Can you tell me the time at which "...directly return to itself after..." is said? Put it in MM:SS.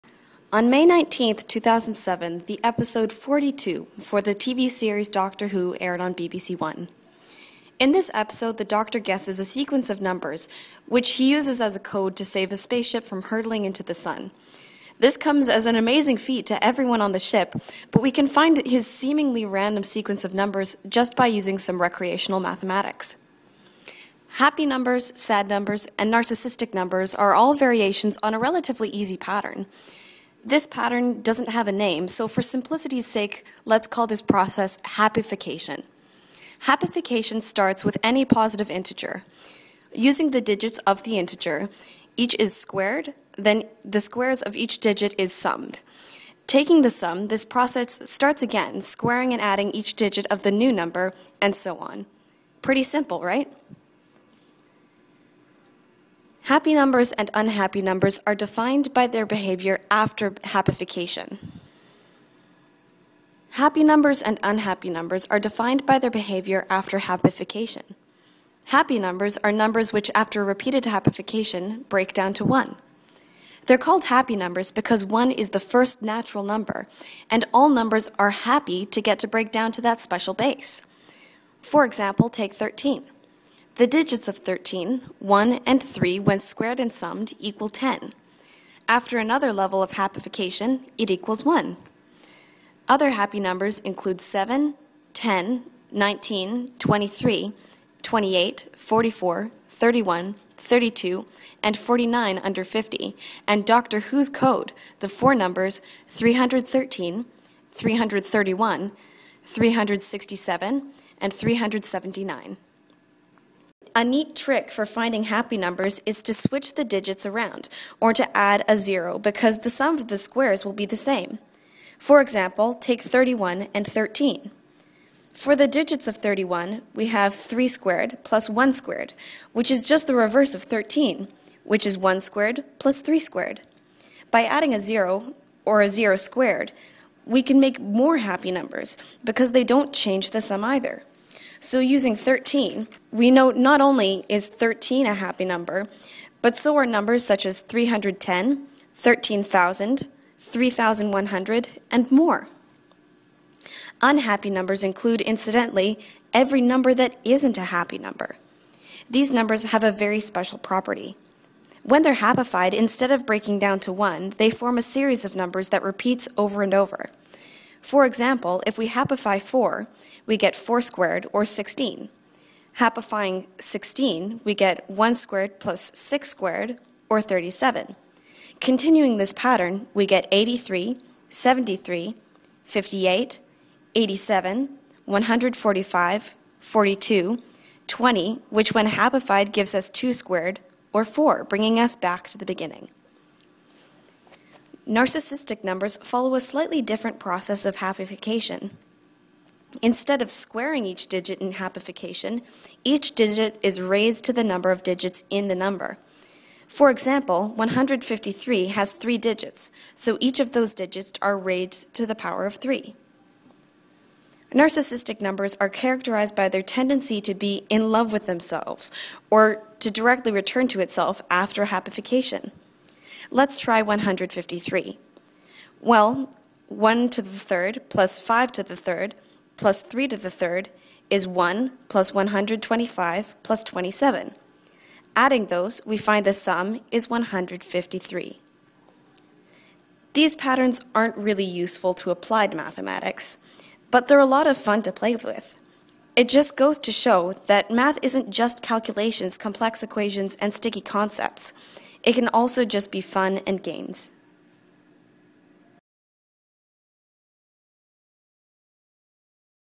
03:39.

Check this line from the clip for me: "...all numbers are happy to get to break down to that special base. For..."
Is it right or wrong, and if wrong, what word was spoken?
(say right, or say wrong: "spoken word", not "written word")
right.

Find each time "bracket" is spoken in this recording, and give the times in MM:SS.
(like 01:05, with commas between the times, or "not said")
not said.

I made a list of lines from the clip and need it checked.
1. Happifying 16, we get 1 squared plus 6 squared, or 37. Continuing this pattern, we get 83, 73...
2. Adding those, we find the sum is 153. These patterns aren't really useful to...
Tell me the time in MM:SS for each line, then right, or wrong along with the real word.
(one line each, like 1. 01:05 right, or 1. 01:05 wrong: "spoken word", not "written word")
1. 02:52 right
2. 03:55 right.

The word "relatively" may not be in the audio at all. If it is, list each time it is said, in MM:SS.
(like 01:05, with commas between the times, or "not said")
00:28.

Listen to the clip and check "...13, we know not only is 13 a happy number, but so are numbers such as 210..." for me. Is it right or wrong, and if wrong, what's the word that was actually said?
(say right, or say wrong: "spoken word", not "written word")
wrong: "310", not "210".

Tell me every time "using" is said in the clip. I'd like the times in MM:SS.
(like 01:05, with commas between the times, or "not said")
00:21, 00:39, 02:21.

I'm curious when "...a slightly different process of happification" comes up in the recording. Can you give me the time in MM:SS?
03:16.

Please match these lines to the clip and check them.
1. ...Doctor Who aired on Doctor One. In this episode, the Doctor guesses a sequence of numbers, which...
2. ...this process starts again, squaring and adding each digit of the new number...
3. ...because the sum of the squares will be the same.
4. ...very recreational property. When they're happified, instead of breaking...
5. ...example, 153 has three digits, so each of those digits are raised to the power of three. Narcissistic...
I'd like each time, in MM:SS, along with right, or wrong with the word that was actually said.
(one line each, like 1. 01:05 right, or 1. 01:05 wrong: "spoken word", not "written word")
1. 00:05 wrong: "BBC", not "Doctor"
2. 00:47 right
3. 01:59 right
4. 02:39 wrong: "special", not "recreational"
5. 03:26 right.